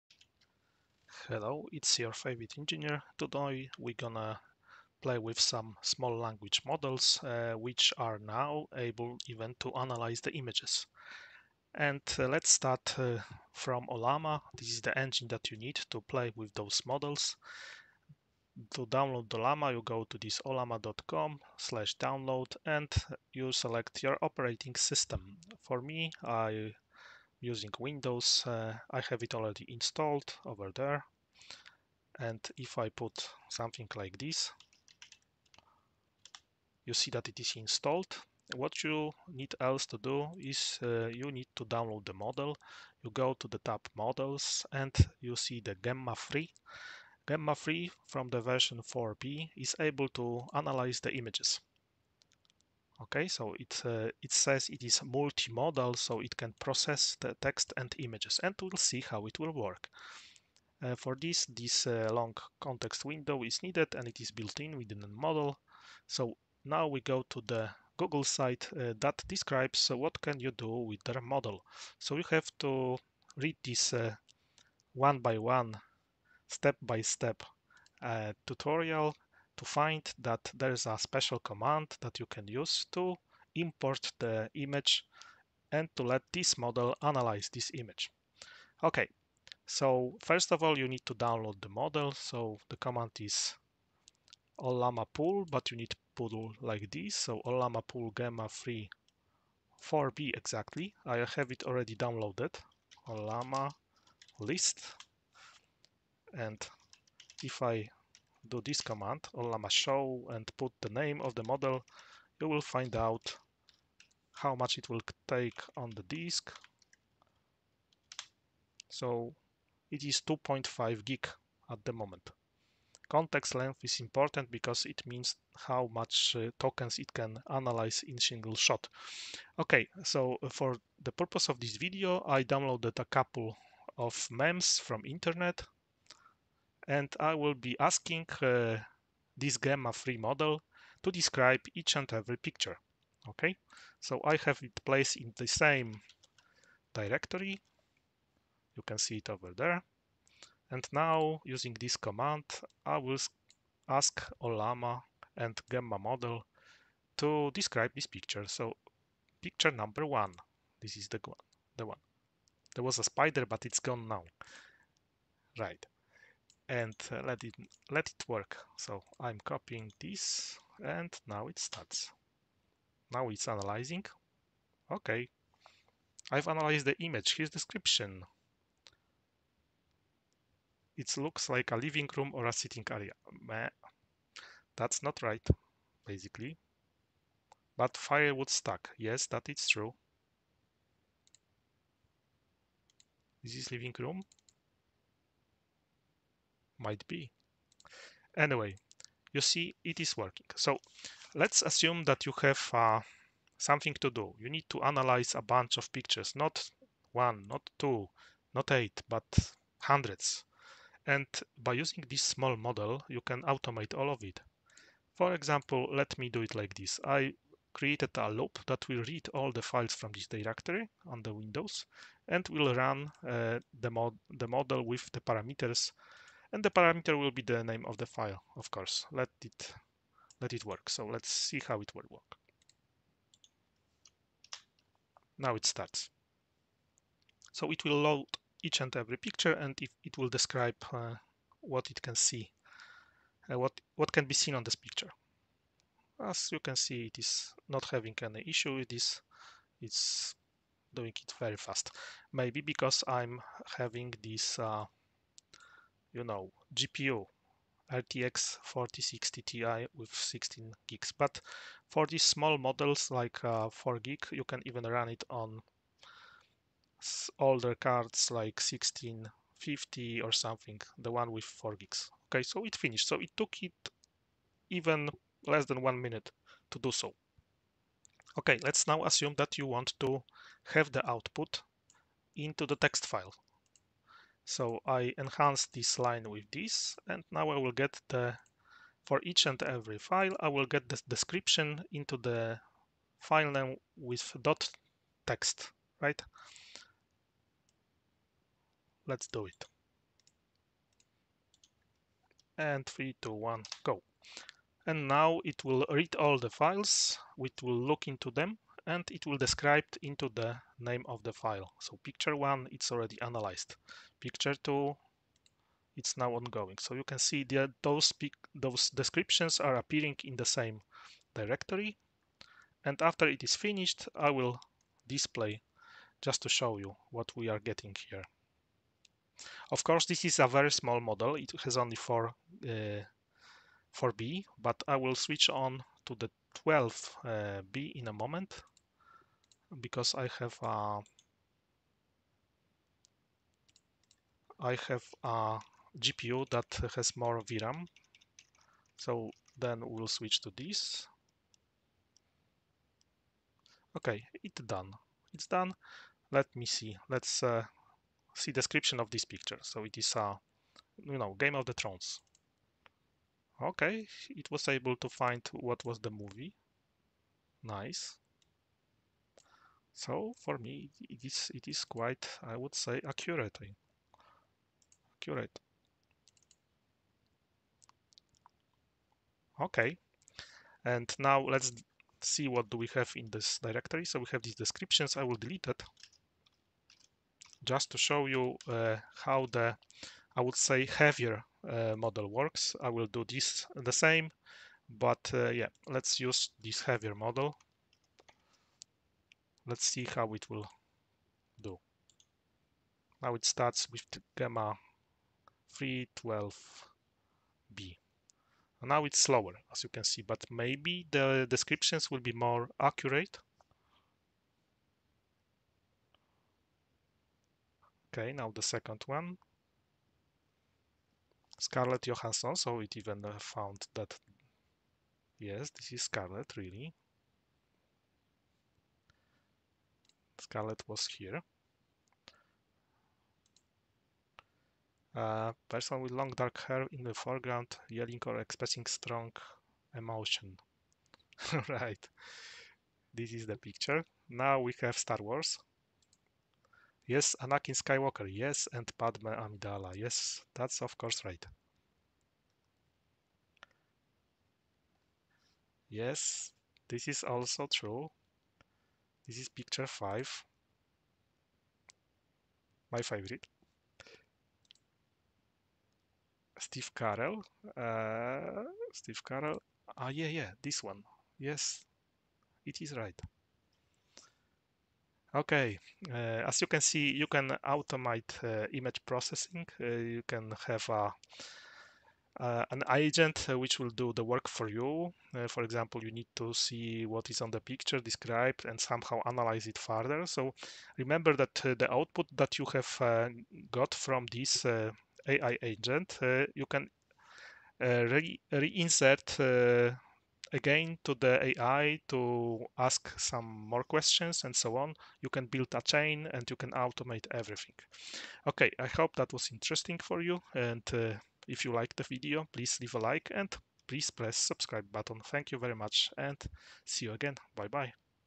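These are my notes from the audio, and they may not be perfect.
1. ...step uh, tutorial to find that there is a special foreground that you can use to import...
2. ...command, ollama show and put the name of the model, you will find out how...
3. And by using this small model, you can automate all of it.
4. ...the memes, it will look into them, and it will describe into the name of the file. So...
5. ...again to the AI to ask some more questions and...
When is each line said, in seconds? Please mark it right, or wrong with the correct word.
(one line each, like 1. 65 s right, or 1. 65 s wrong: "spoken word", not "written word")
1. 77 s wrong: "command", not "foreground"
2. 108 s right
3. 211 s right
4. 306 s wrong: "files", not "memes"
5. 500 s right.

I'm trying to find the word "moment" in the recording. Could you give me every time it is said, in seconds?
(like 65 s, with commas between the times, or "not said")
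121 s, 338 s.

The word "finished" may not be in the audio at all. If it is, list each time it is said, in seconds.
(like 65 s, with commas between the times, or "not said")
272 s, 323 s.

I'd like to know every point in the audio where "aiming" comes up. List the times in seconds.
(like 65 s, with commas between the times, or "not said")
not said.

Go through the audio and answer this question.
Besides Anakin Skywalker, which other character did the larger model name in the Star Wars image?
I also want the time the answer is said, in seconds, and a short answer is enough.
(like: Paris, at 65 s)
Padme Amidala, at 448 s.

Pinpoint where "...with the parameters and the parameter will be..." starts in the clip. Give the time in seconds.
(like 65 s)
224 s.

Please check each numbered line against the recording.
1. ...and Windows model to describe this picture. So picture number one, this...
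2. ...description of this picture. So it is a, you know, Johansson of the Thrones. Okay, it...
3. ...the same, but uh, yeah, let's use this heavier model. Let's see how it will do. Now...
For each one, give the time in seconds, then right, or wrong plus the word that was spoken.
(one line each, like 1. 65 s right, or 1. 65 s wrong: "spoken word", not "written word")
1. 155 s wrong: "Gemma", not "Windows"
2. 358 s wrong: "Game", not "Johansson"
3. 393 s right.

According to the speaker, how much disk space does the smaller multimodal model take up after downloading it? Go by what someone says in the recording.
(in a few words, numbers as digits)
2.5 gig.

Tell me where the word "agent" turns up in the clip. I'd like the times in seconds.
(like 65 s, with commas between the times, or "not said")
482 s, 495 s.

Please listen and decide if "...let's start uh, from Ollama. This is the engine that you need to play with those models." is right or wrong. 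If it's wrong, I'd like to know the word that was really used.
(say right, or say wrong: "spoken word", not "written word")
right.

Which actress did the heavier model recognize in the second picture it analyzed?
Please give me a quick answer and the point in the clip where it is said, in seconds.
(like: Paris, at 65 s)
Scarlett Johansson, at 421 s.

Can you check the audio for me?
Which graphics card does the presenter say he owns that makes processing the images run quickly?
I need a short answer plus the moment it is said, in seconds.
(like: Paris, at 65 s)
RTX 4060 Ti, at 257 s.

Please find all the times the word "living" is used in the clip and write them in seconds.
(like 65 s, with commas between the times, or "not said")
181 s, 193 s.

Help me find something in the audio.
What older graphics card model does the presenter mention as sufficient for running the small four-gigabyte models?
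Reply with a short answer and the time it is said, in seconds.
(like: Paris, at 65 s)
1650, at 268 s.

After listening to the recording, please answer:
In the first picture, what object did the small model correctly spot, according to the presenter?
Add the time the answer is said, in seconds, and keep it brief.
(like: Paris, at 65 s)
firewood stack, at 187 s.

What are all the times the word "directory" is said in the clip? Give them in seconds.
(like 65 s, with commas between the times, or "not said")
146 s, 220 s, 321 s, 383 s.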